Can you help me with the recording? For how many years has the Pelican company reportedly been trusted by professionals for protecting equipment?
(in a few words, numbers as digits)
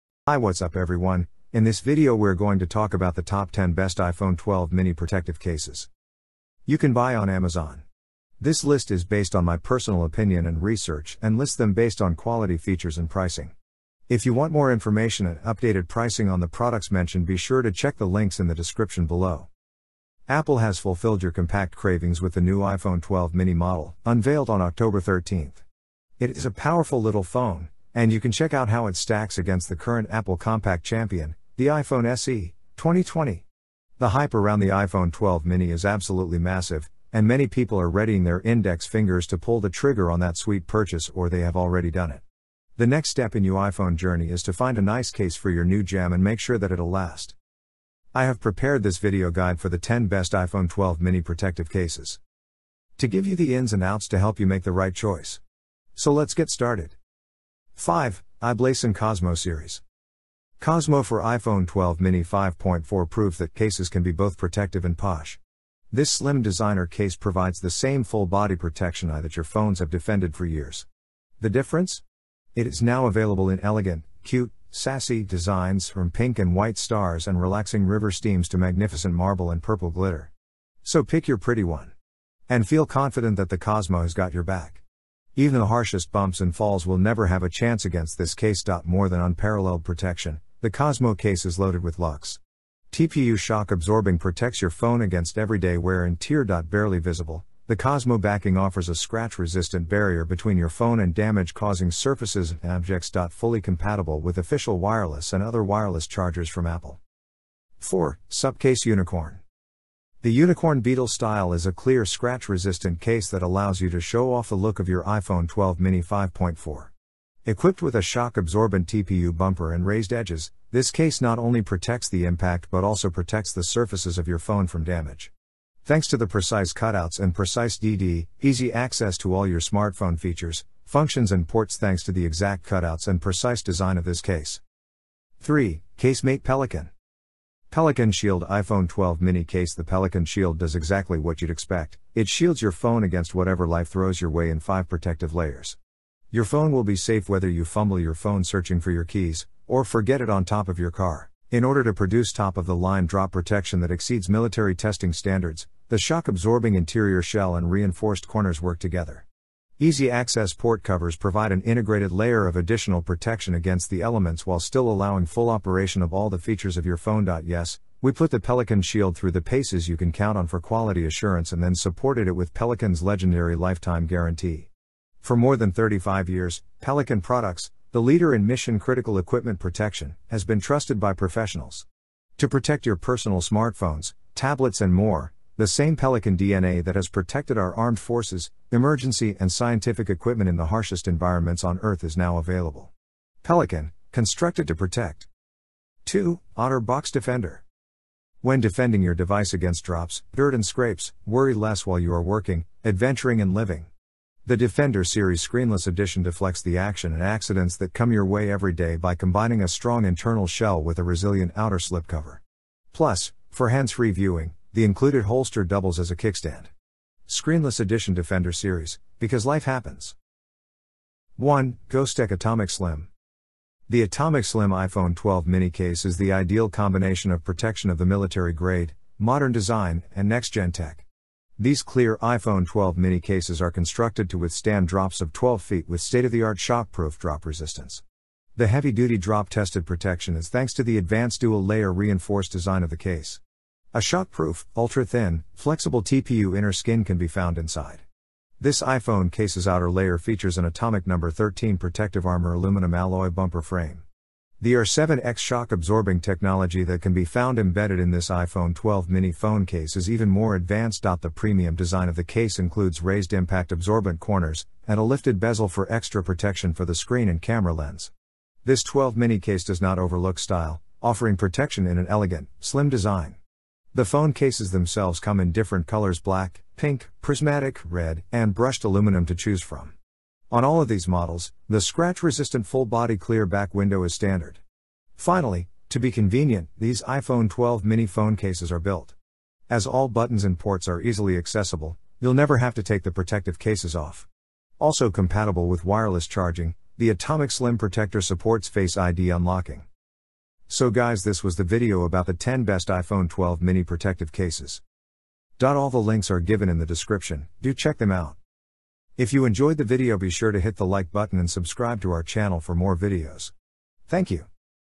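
35 years.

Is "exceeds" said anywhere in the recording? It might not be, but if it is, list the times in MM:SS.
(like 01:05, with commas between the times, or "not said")
02:33.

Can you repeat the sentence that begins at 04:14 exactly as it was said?
The R7X shock absorbing technology that can be found embedded in this iPhone 12 mini phone case is even more advanced.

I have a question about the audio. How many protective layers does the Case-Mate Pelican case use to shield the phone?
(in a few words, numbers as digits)
5.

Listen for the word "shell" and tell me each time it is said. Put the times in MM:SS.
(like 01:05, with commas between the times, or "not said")
02:37, 03:30.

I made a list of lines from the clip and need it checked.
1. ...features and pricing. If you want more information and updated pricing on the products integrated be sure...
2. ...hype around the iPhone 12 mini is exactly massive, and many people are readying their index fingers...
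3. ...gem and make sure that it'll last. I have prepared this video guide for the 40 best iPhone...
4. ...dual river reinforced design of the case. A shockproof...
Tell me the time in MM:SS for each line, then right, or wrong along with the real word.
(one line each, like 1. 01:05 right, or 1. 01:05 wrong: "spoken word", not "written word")
1. 00:12 wrong: "mentioned", not "integrated"
2. 00:34 wrong: "absolutely", not "exactly"
3. 00:45 wrong: "10", not "40"
4. 04:01 wrong: "layer", not "river".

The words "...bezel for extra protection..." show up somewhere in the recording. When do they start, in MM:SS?
04:25.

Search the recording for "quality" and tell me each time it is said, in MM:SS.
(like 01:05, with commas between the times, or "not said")
00:12, 02:50.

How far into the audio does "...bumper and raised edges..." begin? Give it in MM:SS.
01:59.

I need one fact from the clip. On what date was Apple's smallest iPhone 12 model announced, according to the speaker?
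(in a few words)
October 13th.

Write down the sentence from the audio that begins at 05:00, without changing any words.
So guys this was the video about the 10 best iPhone 12 mini protective cases.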